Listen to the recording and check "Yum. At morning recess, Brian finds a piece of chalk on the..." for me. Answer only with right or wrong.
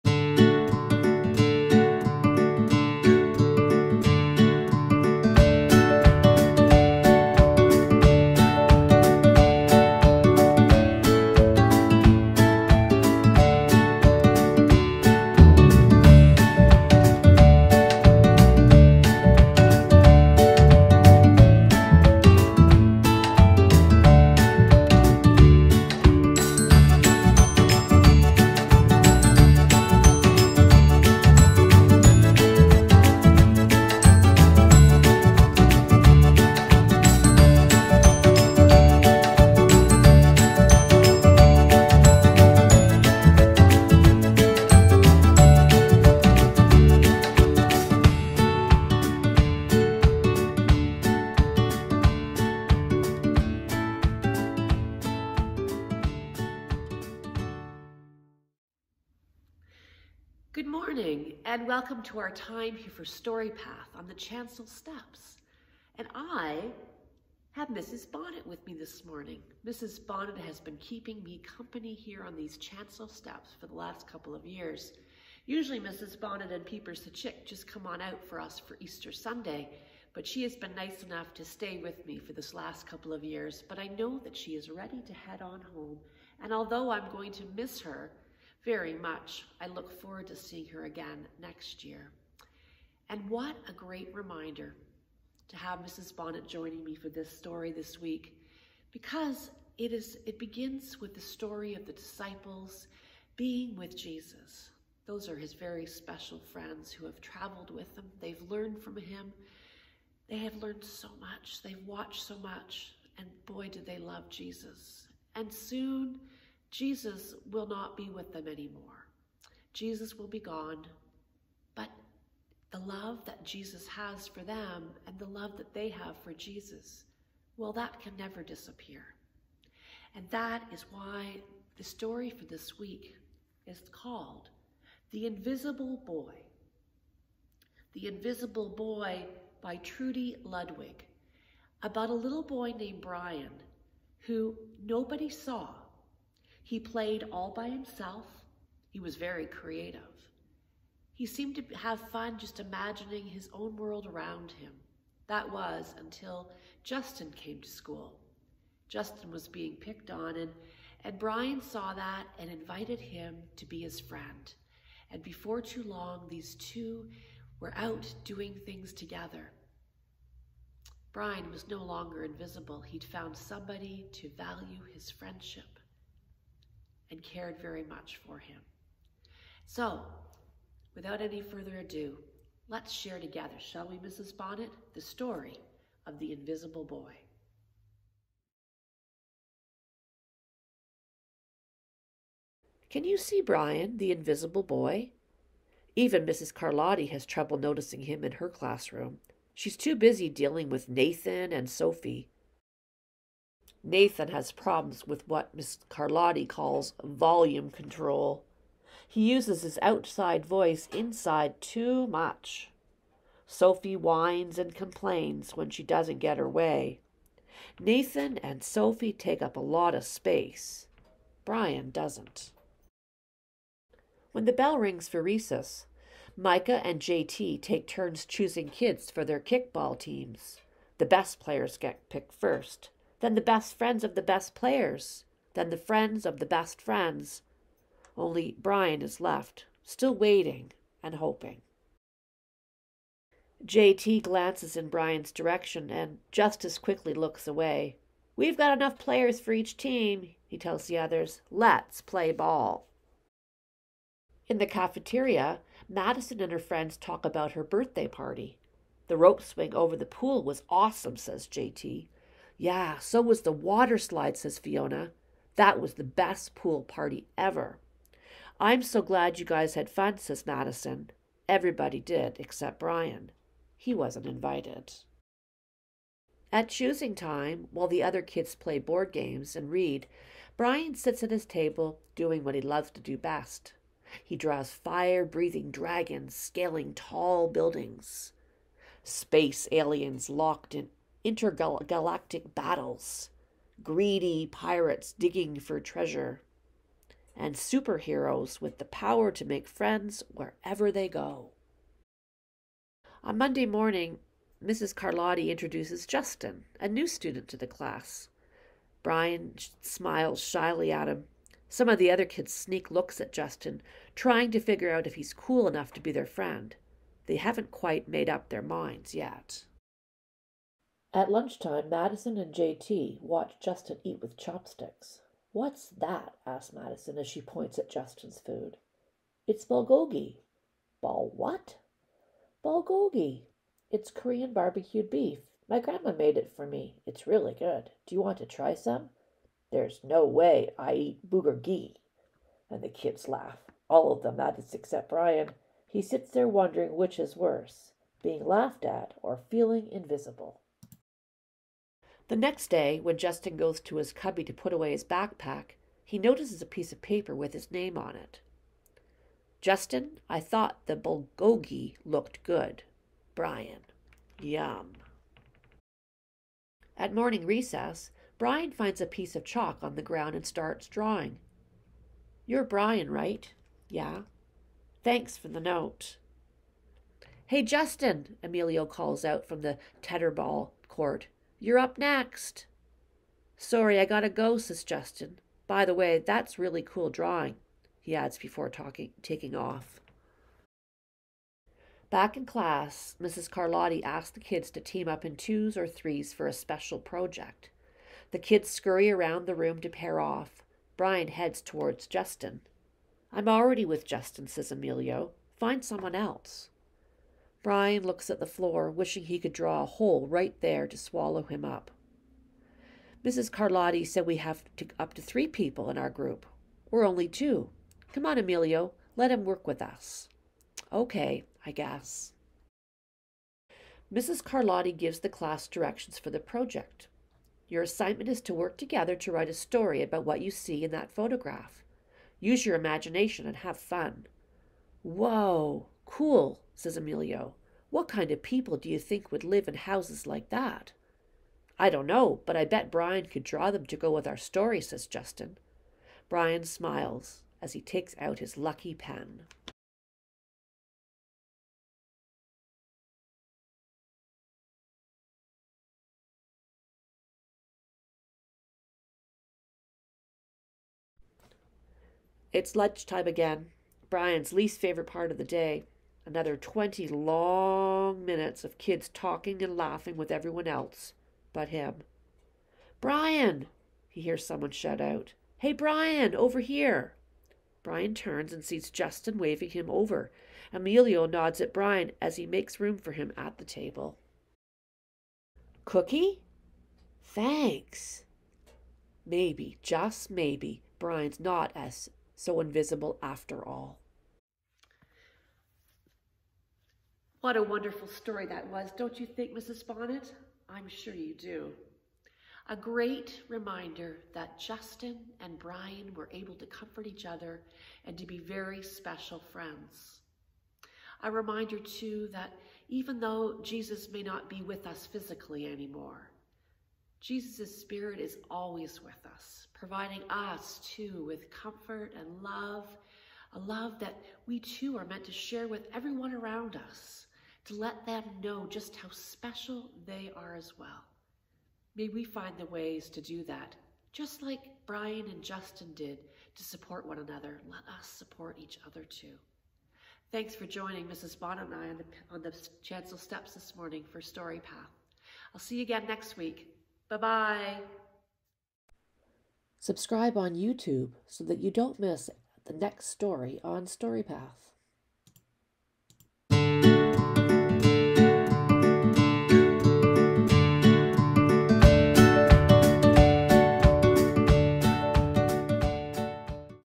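right.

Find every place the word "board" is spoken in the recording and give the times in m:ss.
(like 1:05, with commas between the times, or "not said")
4:38.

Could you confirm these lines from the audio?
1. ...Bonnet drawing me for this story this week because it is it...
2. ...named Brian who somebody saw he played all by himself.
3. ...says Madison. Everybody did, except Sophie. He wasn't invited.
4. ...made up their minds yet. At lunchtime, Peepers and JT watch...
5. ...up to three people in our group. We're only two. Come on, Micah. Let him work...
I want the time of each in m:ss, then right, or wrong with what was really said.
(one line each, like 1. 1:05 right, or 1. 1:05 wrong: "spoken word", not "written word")
1. 1:36 wrong: "joining", not "drawing"
2. 2:22 wrong: "nobody", not "somebody"
3. 4:30 wrong: "Brian", not "Sophie"
4. 5:18 wrong: "Madison", not "Peepers"
5. 6:54 wrong: "Emilio", not "Micah".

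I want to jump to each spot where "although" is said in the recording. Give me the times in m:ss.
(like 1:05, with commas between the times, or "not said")
1:26.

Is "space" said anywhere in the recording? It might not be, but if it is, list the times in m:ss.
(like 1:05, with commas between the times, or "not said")
3:40, 4:49.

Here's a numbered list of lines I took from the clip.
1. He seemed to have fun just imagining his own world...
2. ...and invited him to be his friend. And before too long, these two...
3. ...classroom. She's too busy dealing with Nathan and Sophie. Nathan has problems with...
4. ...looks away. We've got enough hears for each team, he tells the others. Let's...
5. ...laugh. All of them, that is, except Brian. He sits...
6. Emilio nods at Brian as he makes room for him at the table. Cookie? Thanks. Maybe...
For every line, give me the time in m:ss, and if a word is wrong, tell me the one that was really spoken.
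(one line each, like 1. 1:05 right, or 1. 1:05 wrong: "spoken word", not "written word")
1. 2:31 right
2. 2:42 right
3. 3:18 right
4. 4:07 wrong: "players", not "hears"
5. 5:43 right
6. 8:00 right.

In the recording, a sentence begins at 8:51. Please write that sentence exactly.
May we find the ways to do that, just like Brian and Justin did to support one another.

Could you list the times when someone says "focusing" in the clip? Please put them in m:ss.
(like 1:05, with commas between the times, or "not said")
not said.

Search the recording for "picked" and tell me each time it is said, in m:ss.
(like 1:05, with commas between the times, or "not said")
2:39, 3:52.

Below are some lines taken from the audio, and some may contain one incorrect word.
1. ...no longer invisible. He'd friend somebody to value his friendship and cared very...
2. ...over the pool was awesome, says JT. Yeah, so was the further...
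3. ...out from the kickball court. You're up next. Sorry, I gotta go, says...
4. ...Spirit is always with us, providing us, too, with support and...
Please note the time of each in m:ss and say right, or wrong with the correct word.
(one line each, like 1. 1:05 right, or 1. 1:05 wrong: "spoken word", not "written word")
1. 2:51 wrong: "found", not "friend"
2. 4:19 wrong: "water", not "further"
3. 6:19 wrong: "tetherball", not "kickball"
4. 8:37 wrong: "comfort", not "support".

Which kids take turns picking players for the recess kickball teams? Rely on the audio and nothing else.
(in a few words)
Micah and JT.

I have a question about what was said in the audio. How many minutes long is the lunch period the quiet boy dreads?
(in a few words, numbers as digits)
20.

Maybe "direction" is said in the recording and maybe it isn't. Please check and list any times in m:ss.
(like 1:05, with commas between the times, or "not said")
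4:05, 7:05.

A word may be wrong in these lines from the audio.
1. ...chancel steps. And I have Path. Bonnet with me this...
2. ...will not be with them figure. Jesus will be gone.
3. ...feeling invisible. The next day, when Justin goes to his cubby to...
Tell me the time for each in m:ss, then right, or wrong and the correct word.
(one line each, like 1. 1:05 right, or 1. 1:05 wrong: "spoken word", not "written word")
1. 1:04 wrong: "Mrs", not "Path"
2. 1:57 wrong: "anymore", not "figure"
3. 5:49 right.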